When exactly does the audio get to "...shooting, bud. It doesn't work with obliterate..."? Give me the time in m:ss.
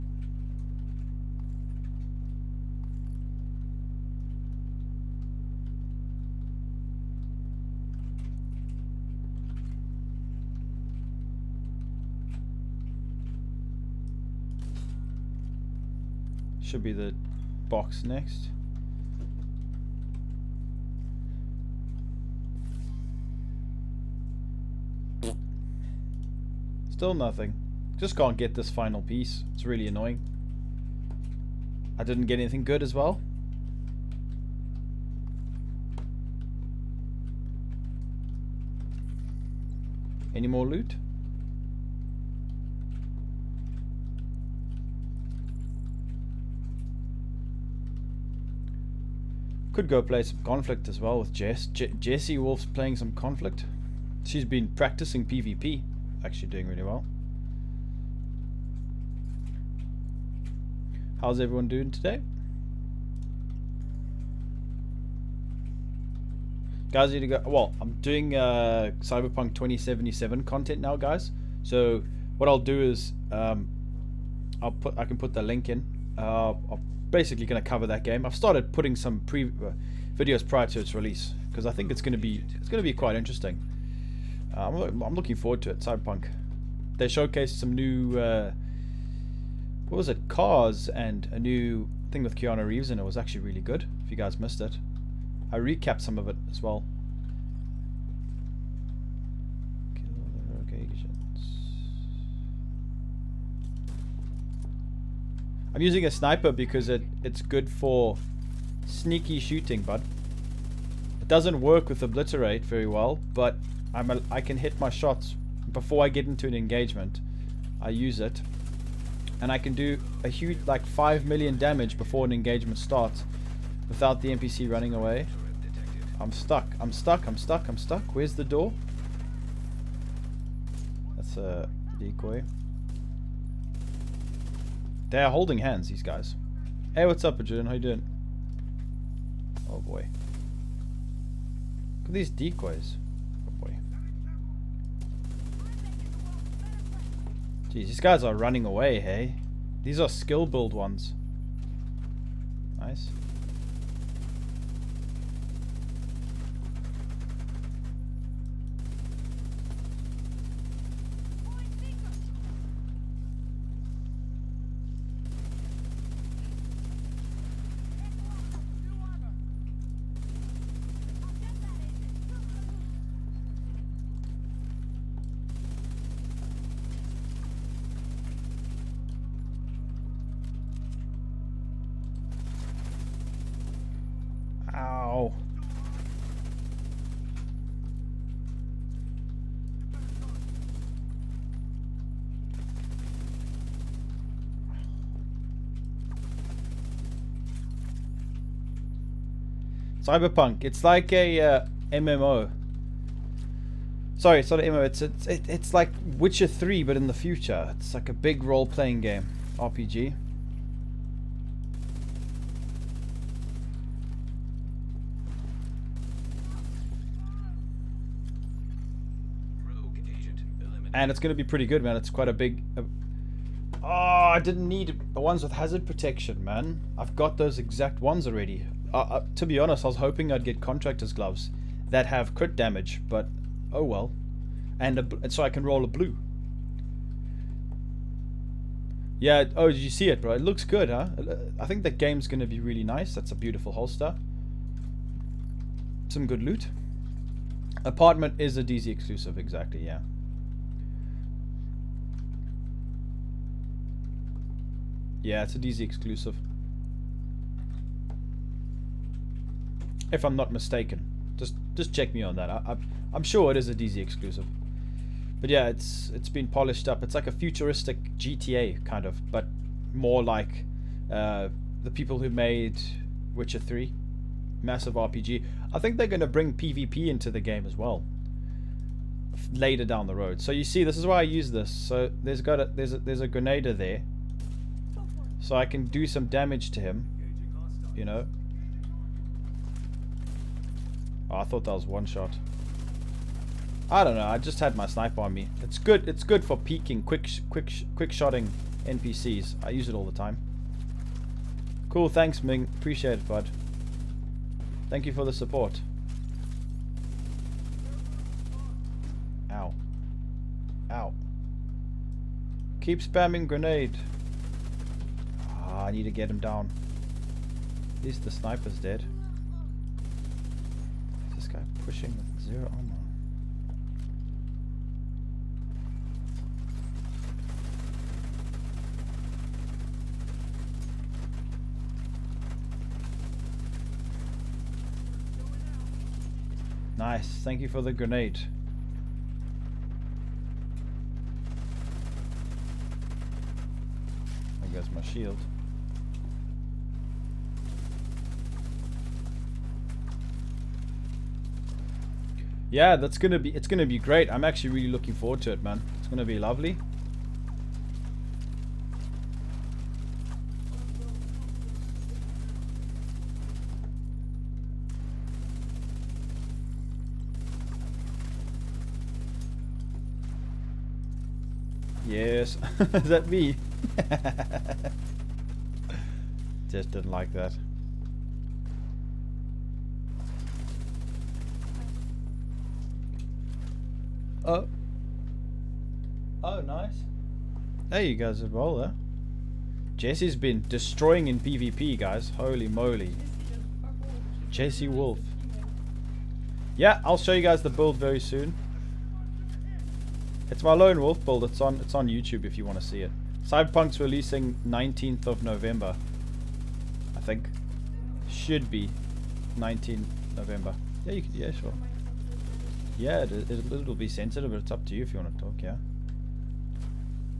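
1:49.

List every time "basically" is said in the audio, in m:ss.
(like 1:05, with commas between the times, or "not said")
1:17.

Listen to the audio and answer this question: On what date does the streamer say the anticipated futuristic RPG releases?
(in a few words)
19 November.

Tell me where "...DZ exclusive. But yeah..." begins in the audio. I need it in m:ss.
4:23.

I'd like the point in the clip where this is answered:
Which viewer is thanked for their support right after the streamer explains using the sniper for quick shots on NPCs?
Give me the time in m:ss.
5:02.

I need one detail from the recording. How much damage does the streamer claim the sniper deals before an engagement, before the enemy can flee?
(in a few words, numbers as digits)
5 million.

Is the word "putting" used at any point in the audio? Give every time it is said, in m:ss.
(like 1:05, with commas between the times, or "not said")
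1:18.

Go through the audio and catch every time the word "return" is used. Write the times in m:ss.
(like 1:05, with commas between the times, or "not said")
not said.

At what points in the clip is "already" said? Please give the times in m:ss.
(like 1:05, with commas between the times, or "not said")
3:48.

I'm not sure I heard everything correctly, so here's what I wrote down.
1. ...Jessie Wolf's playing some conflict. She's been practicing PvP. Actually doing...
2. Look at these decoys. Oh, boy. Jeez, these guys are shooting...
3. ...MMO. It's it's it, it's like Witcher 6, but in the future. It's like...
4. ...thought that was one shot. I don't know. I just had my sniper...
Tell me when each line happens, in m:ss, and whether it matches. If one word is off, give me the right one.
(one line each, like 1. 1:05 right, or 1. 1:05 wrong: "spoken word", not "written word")
1. 0:51 right
2. 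2:22 wrong: "running", not "shooting"
3. 3:24 wrong: "3", not "6"
4. 4:51 right.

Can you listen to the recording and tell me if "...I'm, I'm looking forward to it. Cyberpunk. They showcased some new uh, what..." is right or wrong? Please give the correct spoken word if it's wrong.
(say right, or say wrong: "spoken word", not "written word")
right.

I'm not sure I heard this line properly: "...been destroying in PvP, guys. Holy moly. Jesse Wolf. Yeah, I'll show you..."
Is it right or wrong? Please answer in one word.
right.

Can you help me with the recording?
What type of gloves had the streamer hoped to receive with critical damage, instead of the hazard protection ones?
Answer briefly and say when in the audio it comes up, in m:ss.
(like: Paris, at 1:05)
contractor's gloves, at 3:50.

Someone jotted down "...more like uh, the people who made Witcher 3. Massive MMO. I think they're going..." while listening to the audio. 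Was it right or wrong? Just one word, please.
wrong.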